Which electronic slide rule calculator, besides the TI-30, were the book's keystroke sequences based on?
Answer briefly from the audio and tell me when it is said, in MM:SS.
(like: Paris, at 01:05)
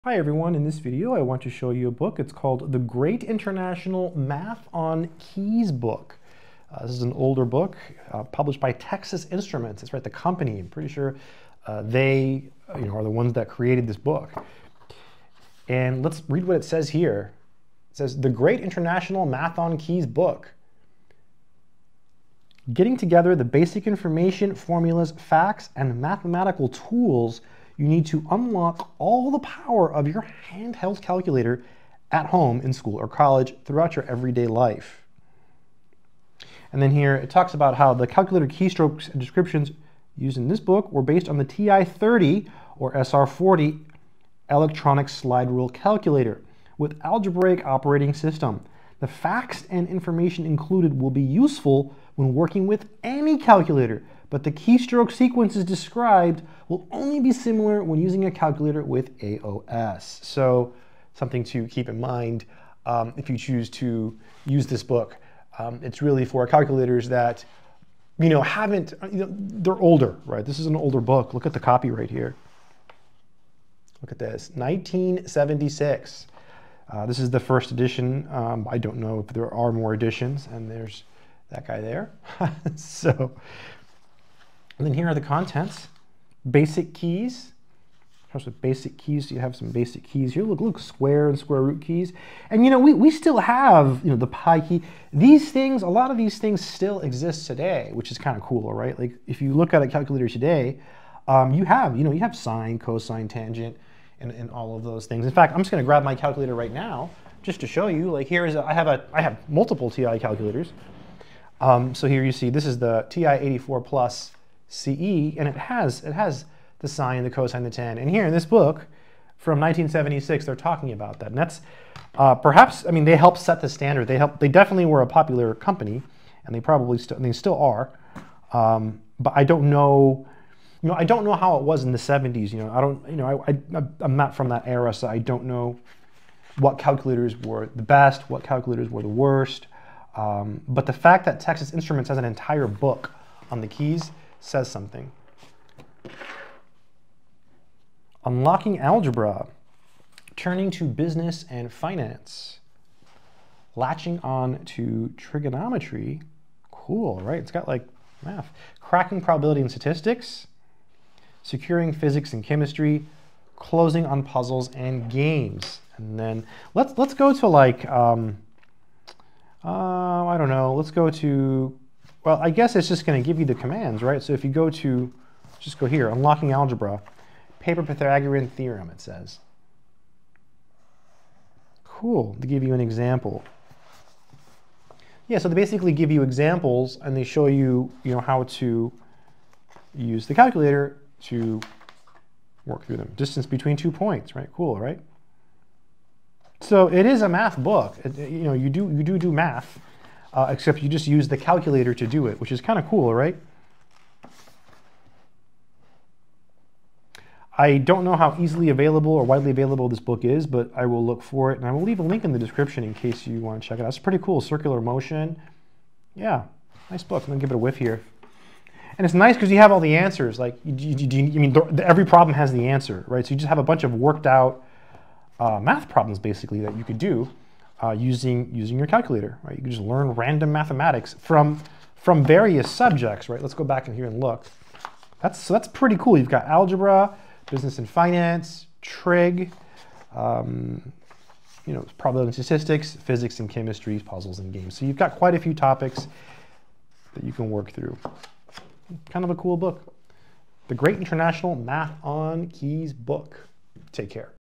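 SR-40, at 00:42.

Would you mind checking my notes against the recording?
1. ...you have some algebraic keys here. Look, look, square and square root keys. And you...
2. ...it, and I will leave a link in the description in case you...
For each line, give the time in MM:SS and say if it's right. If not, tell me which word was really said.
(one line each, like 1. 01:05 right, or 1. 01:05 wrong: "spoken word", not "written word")
1. 01:29 wrong: "basic", not "algebraic"
2. 03:31 right.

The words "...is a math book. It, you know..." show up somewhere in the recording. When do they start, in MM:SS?
03:17.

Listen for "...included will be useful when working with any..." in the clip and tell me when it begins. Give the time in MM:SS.
00:50.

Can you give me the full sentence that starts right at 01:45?
In fact, I'm just gonna grab my calculator right now just to show you.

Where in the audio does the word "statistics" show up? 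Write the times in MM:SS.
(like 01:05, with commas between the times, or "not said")
02:39, 04:02.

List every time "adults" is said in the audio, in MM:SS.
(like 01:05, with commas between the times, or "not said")
not said.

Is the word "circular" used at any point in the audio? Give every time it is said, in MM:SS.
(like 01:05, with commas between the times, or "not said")
03:34.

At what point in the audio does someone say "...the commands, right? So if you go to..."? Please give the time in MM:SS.
02:53.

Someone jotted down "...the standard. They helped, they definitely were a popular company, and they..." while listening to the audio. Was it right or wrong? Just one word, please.
right.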